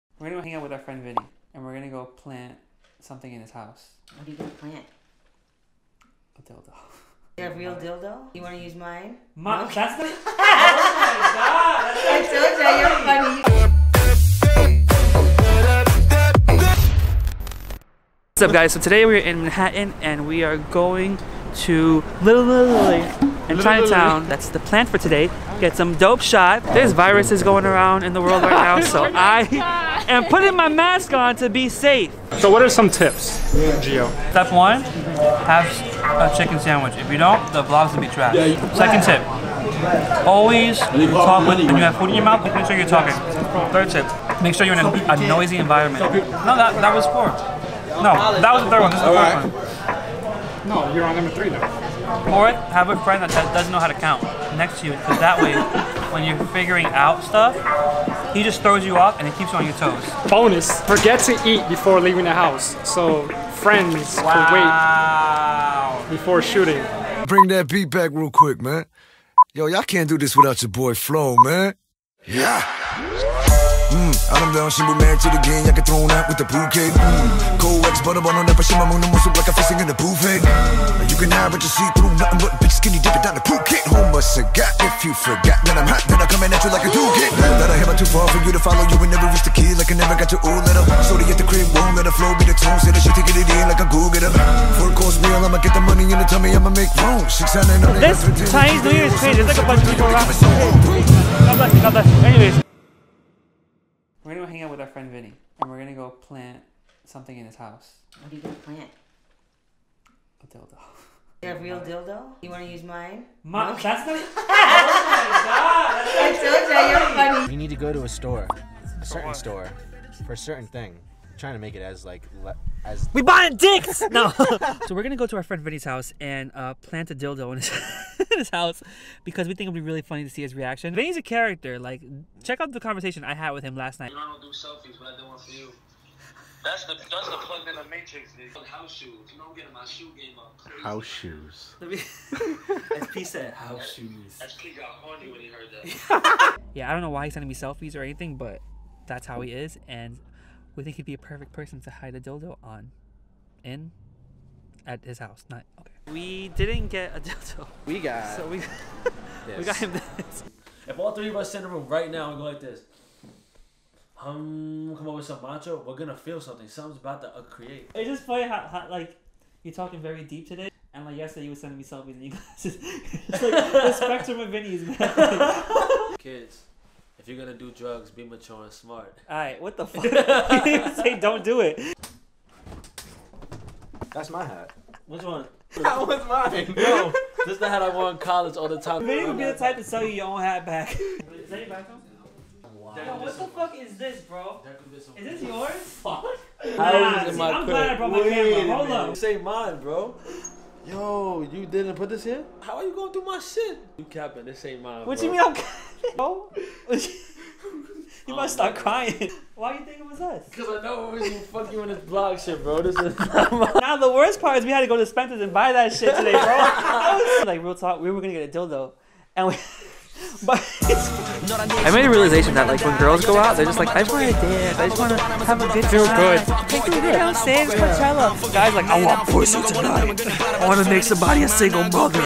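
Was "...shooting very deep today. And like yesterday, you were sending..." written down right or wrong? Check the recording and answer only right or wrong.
wrong.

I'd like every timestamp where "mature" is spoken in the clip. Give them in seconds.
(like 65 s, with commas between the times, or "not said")
178 s.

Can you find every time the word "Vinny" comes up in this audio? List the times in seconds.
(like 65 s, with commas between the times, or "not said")
1 s, 105 s, 125 s, 130 s, 174 s, 189 s.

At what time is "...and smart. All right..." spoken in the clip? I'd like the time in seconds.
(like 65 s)
178 s.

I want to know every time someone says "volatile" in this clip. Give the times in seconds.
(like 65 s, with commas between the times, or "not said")
not said.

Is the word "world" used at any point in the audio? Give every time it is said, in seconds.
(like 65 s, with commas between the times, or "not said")
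28 s.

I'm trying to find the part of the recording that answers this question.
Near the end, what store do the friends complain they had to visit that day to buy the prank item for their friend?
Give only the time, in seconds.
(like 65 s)
215 s.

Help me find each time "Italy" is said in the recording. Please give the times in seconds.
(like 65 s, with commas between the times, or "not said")
22 s.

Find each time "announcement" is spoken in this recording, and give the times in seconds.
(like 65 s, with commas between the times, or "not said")
not said.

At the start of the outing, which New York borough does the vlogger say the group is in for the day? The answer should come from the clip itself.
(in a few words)
Manhattan.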